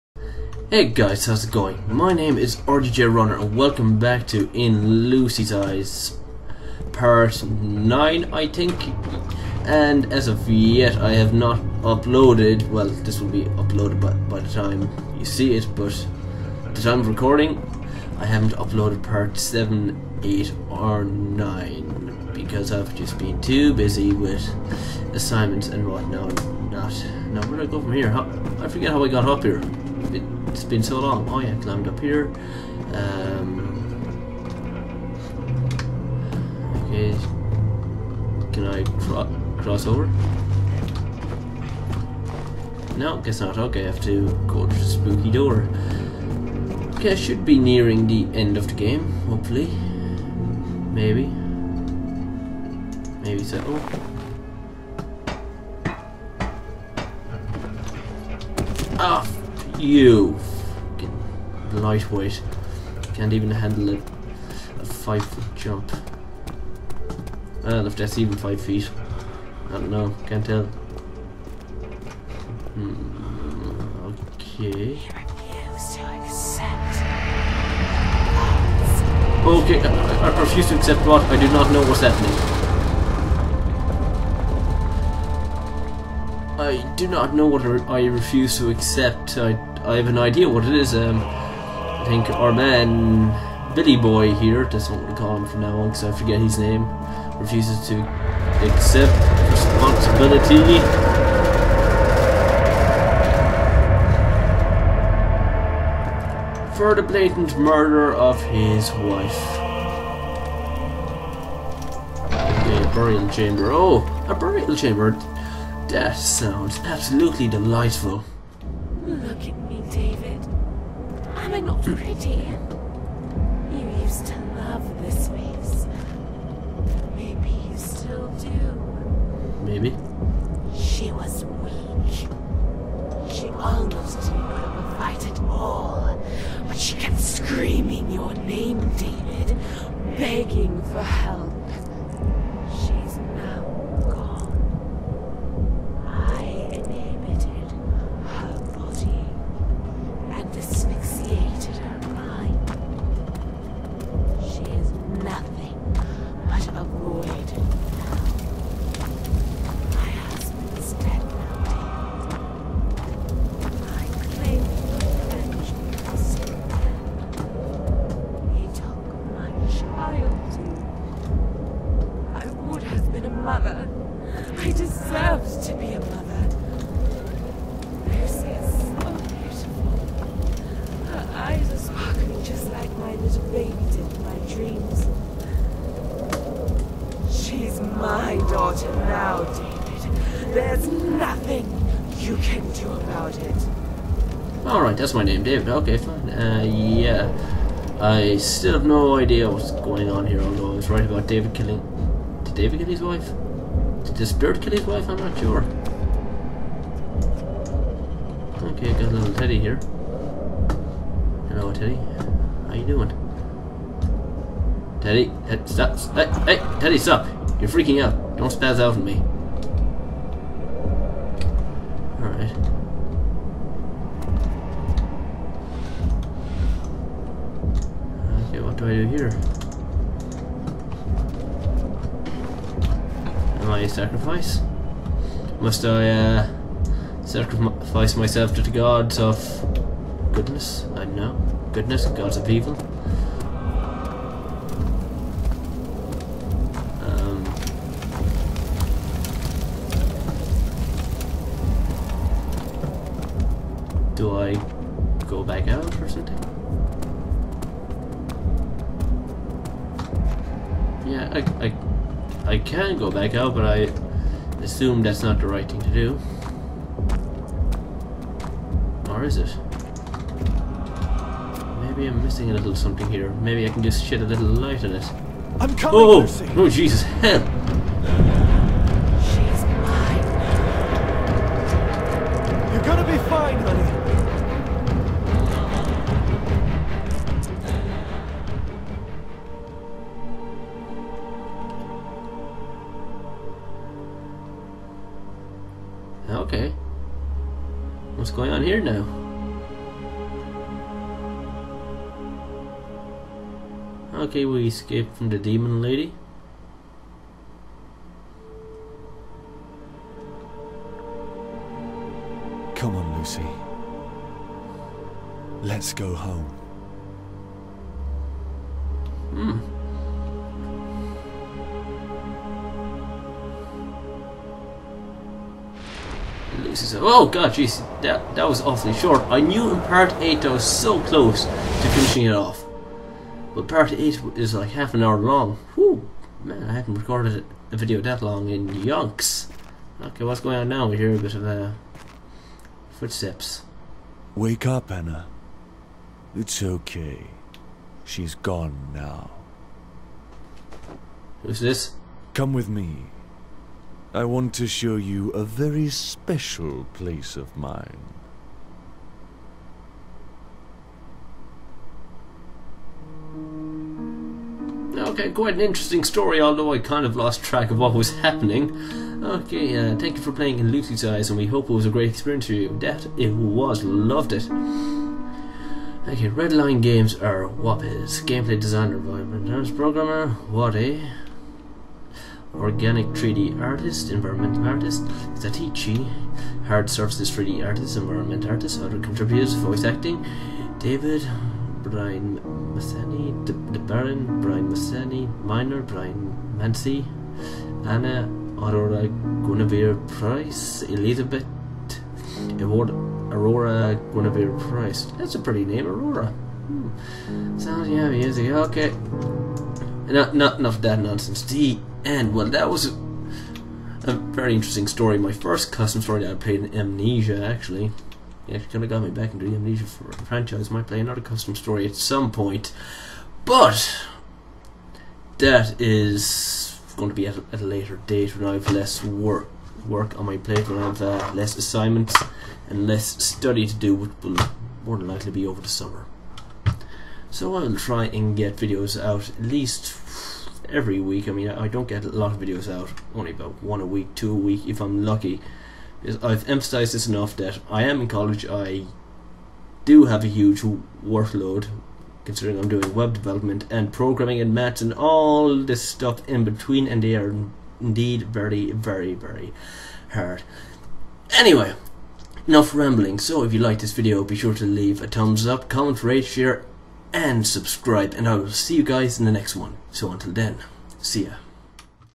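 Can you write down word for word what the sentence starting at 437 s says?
So I'll try and get videos out at least every week.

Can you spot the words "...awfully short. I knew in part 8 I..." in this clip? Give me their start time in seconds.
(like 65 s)
328 s.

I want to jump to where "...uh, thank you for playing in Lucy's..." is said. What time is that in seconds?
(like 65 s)
369 s.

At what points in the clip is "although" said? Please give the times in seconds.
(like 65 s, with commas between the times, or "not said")
200 s, 366 s.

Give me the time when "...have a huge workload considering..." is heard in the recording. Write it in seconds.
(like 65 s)
450 s.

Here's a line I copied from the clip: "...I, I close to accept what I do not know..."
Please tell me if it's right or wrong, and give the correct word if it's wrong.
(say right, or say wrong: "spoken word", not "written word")
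wrong: "refuse", not "close".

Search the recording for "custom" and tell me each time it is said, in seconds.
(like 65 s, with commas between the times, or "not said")
415 s, 421 s.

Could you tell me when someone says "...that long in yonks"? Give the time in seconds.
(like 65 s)
338 s.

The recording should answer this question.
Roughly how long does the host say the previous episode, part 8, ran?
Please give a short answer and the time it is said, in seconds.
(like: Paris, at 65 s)
Half an hour, at 334 s.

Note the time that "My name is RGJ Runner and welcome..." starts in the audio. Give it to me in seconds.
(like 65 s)
1 s.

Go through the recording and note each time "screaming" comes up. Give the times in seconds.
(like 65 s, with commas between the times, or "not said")
137 s.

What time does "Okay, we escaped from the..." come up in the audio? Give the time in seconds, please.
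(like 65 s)
304 s.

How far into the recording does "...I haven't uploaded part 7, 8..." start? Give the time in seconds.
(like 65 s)
18 s.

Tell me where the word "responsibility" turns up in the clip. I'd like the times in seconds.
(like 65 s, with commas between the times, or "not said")
99 s.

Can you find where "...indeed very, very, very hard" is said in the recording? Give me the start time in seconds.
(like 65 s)
457 s.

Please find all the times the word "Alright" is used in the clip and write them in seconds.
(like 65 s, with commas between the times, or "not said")
194 s, 222 s.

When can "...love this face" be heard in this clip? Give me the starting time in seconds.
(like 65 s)
124 s.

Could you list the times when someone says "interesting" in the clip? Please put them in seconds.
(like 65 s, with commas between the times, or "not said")
365 s, 414 s.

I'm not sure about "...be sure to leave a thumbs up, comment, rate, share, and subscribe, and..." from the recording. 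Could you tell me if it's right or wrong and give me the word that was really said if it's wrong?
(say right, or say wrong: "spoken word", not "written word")
right.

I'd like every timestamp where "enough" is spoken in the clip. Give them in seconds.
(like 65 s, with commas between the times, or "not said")
410 s, 447 s, 462 s.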